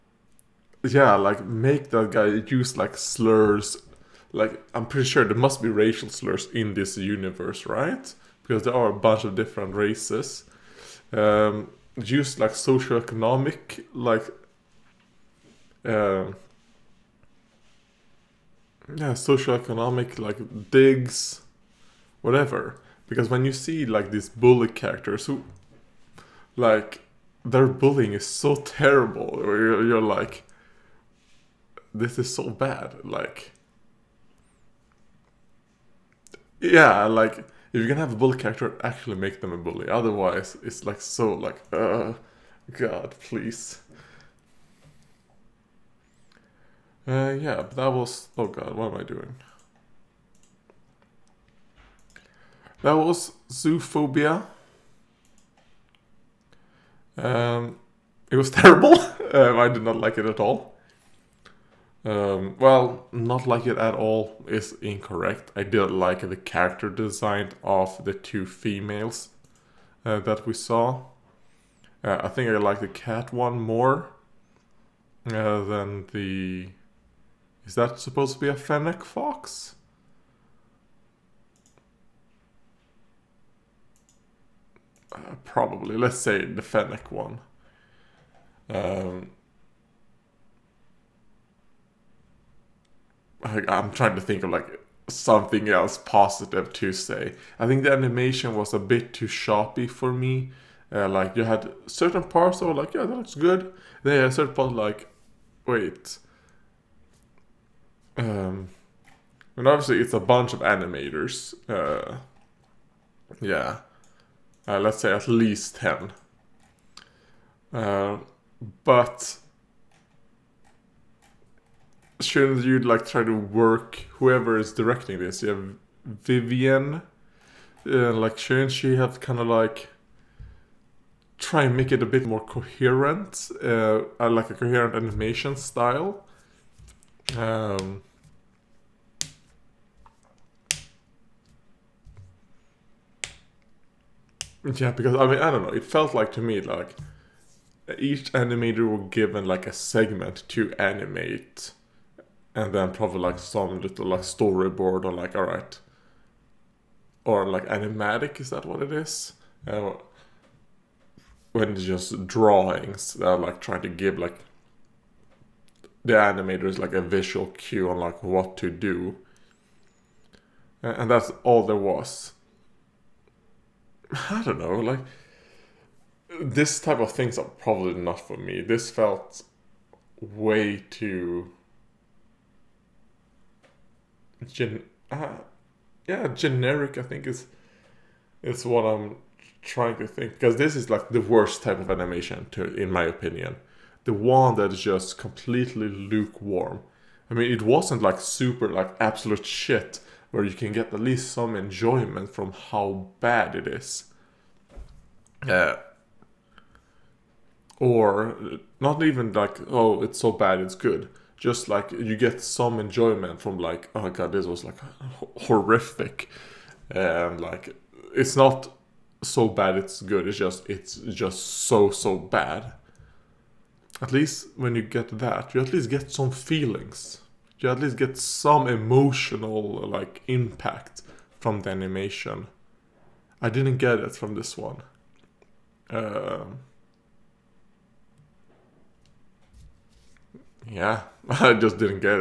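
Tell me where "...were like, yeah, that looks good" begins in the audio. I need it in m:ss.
1:42.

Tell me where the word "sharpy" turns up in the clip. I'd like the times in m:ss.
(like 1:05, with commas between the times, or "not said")
1:39.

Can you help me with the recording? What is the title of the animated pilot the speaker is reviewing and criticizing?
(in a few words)
Zoophobia.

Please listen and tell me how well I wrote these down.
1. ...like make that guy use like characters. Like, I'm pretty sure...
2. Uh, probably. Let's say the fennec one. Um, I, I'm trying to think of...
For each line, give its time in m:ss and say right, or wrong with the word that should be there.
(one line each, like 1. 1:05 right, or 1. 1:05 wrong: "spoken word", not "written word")
1. 0:01 wrong: "slurs", not "characters"
2. 1:25 right.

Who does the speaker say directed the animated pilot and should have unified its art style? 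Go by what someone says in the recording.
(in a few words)
Vivian.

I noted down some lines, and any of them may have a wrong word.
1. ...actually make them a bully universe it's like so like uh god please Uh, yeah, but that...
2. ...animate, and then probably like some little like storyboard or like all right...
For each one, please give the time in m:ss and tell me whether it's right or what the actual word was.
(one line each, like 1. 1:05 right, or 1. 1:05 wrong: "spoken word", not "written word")
1. 0:38 wrong: "otherwise", not "universe"
2. 2:30 right.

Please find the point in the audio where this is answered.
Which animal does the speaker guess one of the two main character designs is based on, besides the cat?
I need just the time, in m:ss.
1:18.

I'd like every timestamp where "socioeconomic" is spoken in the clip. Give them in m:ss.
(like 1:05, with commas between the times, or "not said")
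0:12, 0:19.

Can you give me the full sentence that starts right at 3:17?
I mean, it wasn't like super, like absolute shit, where you can get at least some enjoyment from how bad it is.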